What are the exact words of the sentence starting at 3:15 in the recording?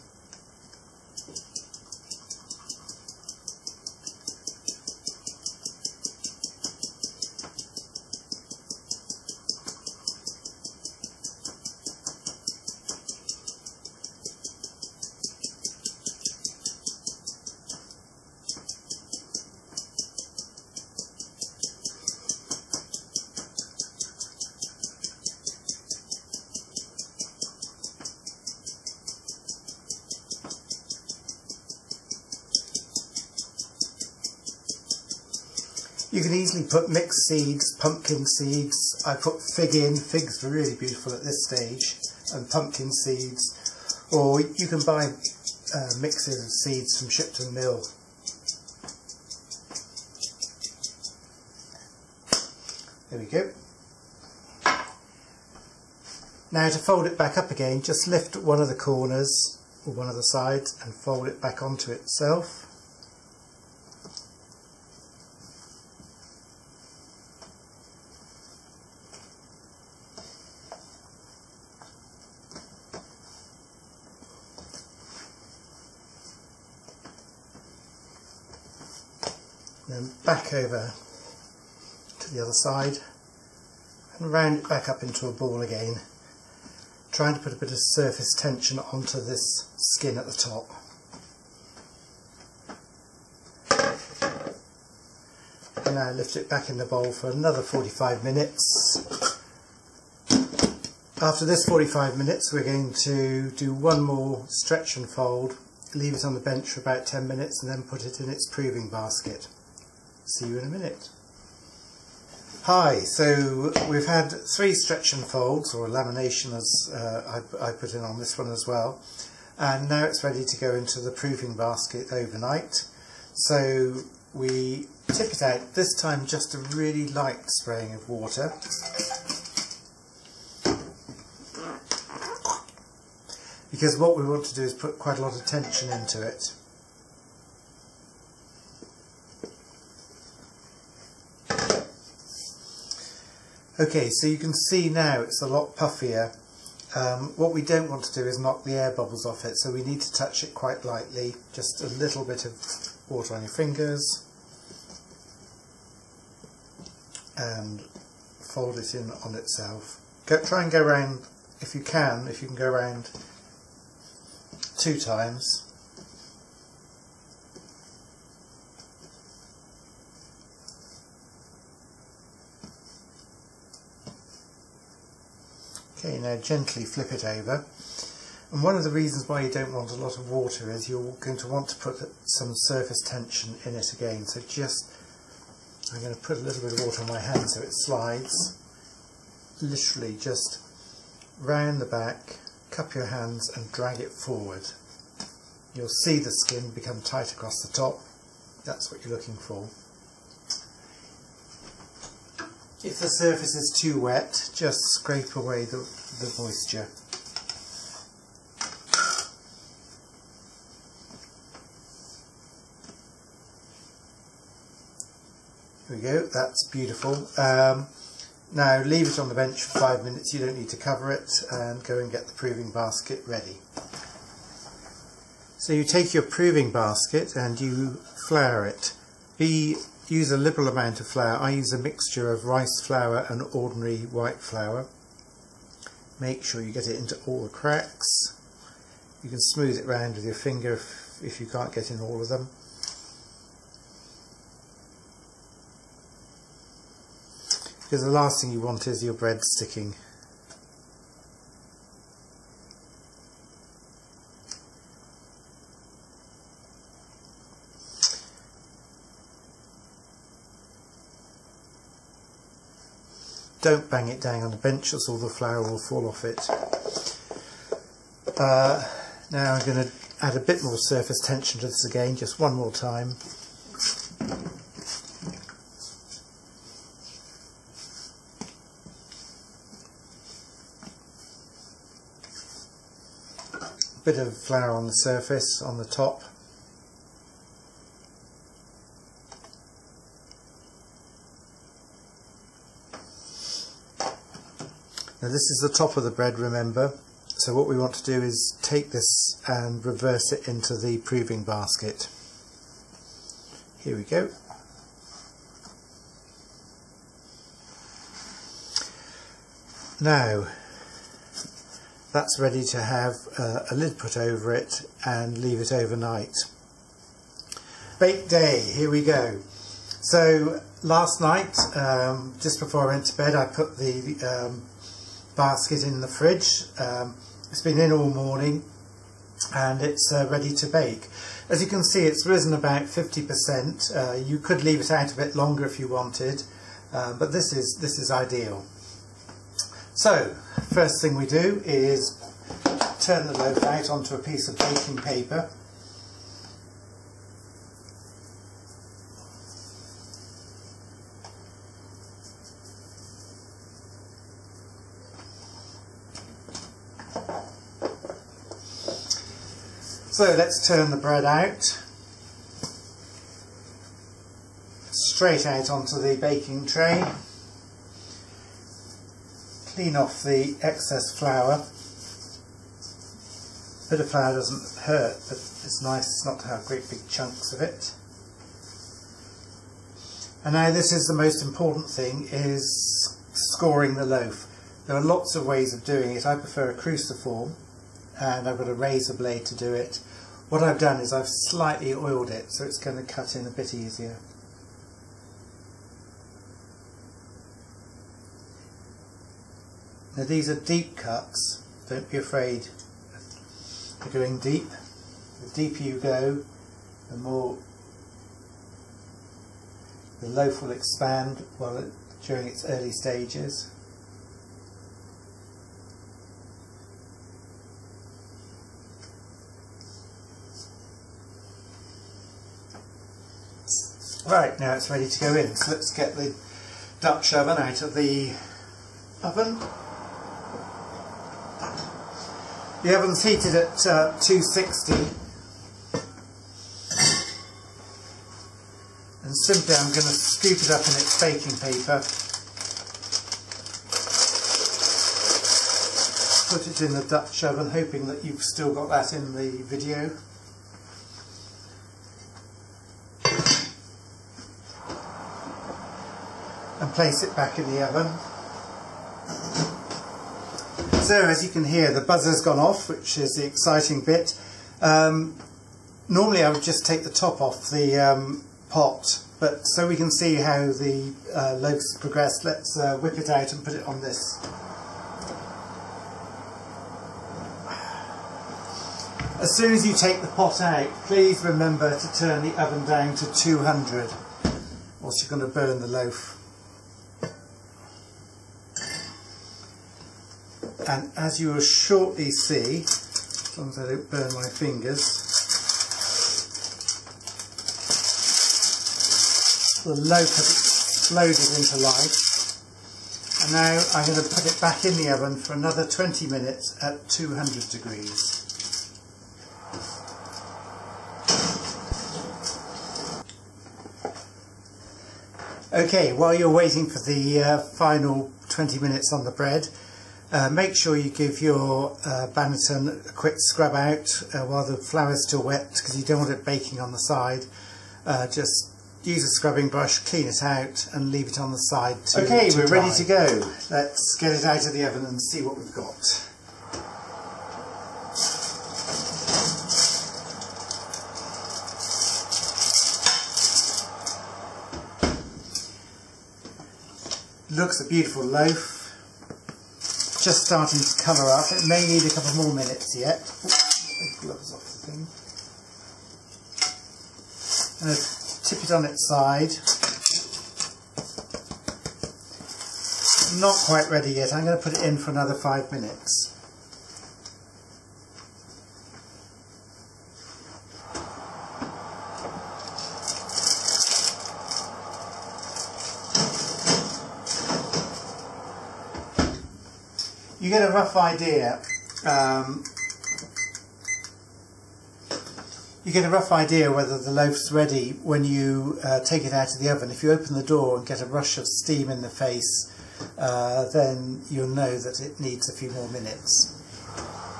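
You'll see the skin become tight across the top.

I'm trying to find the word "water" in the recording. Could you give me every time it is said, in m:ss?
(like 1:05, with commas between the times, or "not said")
2:08, 2:33, 3:00, 3:06.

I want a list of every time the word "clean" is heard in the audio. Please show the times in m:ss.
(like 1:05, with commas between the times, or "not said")
6:09, 8:49.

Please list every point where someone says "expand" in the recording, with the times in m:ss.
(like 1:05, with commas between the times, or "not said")
6:50.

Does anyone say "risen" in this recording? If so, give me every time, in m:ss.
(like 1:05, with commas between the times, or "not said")
5:32.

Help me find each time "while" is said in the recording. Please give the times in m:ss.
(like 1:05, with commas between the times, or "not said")
6:51, 8:36, 8:44.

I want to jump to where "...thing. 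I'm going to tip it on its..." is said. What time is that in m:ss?
9:14.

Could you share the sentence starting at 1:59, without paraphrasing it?
And now it's ready to go into the proofing basket overnight.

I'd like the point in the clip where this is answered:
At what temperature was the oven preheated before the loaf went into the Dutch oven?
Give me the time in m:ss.
7:14.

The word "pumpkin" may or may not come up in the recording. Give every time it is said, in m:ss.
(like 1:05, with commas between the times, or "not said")
0:37, 0:42.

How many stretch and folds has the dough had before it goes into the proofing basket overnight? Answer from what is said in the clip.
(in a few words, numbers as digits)
3.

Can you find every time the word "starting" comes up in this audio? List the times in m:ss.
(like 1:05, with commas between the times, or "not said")
9:10.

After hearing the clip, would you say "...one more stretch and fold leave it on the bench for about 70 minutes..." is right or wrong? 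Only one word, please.
wrong.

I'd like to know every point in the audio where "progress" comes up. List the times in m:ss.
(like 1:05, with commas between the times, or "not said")
7:51.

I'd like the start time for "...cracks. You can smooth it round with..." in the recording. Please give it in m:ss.
3:57.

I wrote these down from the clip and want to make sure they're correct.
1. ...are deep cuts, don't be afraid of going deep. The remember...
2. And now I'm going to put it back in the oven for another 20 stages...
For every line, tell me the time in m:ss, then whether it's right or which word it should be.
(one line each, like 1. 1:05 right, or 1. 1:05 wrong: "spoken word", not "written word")
1. 6:40 wrong: "deeper", not "remember"
2. 8:23 wrong: "minutes", not "stages".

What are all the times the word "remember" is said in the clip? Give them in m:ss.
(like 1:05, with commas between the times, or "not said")
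4:56, 8:01.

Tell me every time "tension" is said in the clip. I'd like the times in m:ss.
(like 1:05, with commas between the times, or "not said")
1:28, 2:15, 3:03, 4:31.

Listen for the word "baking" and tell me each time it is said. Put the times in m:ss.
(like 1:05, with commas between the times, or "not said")
5:44, 6:06, 7:21, 8:46.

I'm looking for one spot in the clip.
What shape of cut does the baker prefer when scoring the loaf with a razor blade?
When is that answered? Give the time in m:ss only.
6:26.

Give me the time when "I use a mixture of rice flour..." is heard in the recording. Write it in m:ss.
3:51.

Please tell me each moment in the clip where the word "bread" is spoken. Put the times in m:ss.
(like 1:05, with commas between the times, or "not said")
4:09, 4:56, 6:00, 8:39.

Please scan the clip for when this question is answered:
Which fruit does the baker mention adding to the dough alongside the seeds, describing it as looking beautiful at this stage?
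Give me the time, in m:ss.
0:39.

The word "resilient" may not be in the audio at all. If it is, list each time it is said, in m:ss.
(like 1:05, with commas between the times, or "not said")
not said.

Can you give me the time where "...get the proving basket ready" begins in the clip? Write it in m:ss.
3:42.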